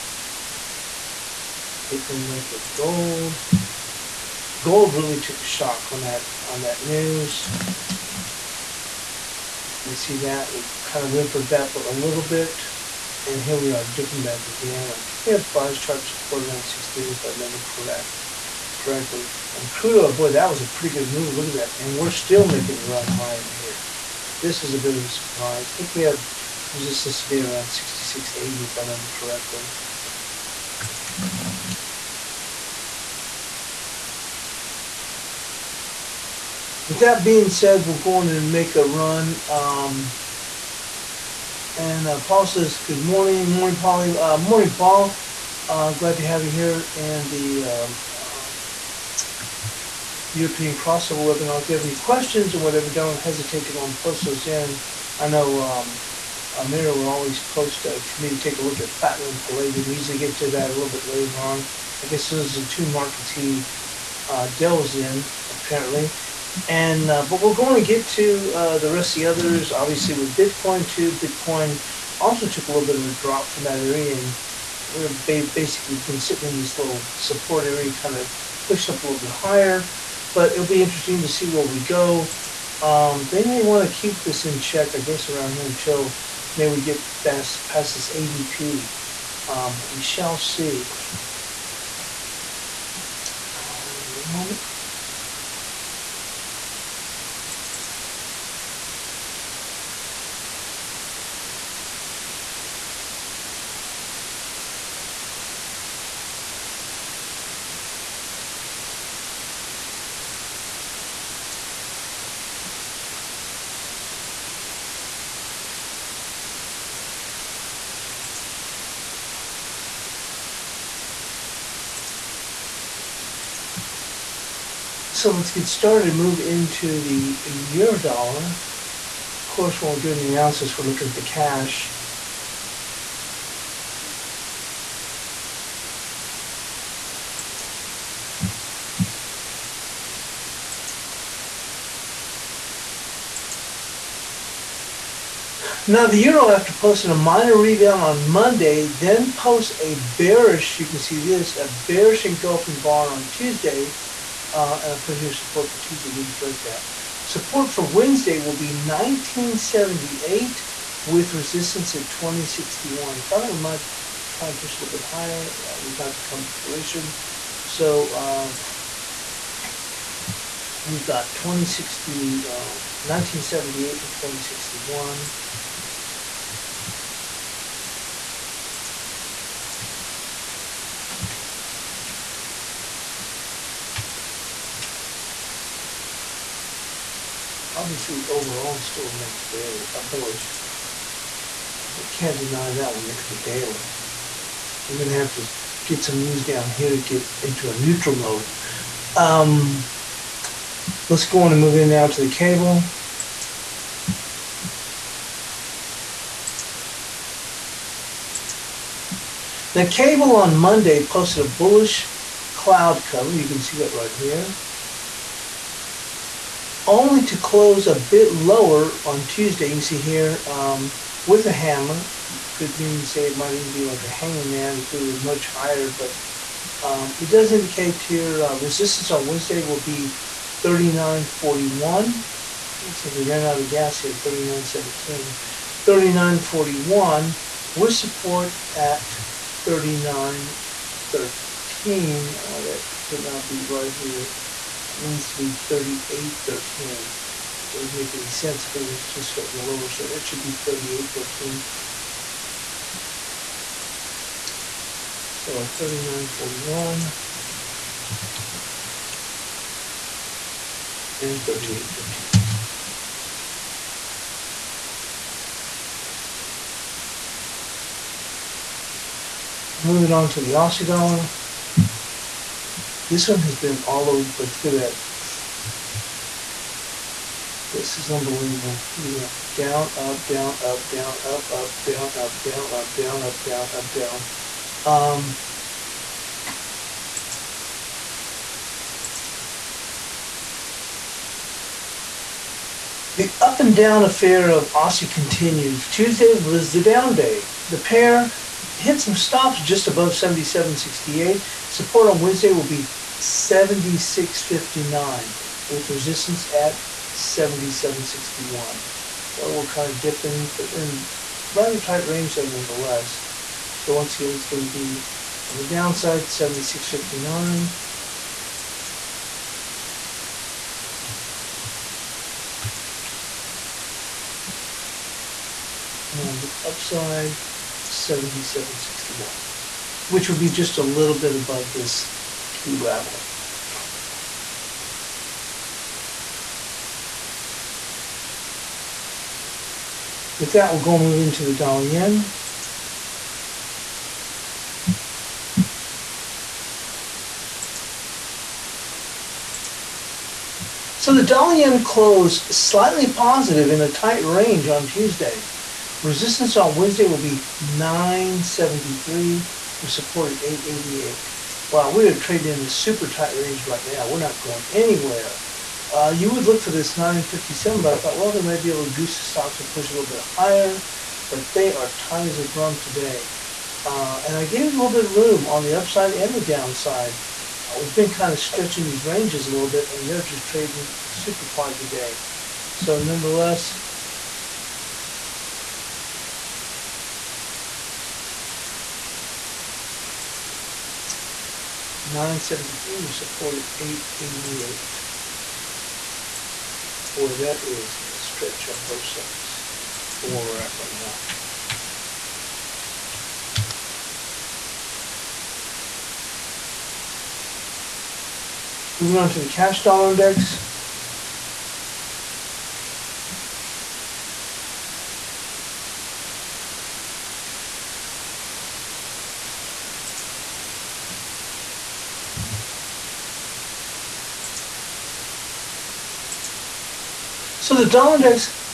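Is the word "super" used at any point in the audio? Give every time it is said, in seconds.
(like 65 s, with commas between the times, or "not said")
362 s, 381 s.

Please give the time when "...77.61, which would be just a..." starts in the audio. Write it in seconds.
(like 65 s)
327 s.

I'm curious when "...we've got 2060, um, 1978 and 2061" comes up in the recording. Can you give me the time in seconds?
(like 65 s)
170 s.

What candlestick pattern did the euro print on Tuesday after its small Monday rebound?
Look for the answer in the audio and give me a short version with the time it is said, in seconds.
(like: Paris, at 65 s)
bearish engulfing bar, at 151 s.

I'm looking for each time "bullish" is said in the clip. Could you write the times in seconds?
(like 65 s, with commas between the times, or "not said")
190 s, 211 s.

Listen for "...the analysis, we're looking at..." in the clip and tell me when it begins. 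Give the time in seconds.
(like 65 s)
130 s.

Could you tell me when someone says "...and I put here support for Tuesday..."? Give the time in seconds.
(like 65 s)
154 s.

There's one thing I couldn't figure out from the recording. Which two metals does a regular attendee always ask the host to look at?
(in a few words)
platinum and palladium.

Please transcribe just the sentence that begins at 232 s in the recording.
Looks like we ran out of gas here, 39.17.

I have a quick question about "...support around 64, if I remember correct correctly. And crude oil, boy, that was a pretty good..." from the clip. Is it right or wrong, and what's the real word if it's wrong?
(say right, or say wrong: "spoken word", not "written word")
wrong: "68", not "64".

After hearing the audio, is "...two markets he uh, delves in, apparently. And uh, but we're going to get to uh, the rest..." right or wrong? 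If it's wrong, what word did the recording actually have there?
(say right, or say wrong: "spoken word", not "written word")
right.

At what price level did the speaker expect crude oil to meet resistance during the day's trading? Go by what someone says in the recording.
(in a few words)
66.80.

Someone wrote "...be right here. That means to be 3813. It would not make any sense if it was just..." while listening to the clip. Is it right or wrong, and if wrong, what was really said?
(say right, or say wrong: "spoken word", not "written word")
right.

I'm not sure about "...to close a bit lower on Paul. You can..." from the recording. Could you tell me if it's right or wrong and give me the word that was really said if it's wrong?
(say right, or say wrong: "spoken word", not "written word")
wrong: "Tuesday", not "Paul".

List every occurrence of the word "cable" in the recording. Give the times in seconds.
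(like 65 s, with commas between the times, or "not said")
202 s, 209 s.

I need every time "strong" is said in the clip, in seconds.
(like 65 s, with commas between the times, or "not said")
not said.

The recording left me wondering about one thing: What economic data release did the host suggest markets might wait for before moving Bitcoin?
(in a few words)
ADP.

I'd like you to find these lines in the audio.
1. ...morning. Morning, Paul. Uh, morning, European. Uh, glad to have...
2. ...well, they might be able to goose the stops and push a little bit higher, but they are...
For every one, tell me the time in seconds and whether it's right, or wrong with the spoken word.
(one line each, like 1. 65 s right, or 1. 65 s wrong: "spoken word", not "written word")
1. 43 s wrong: "Paul", not "European"
2. 368 s right.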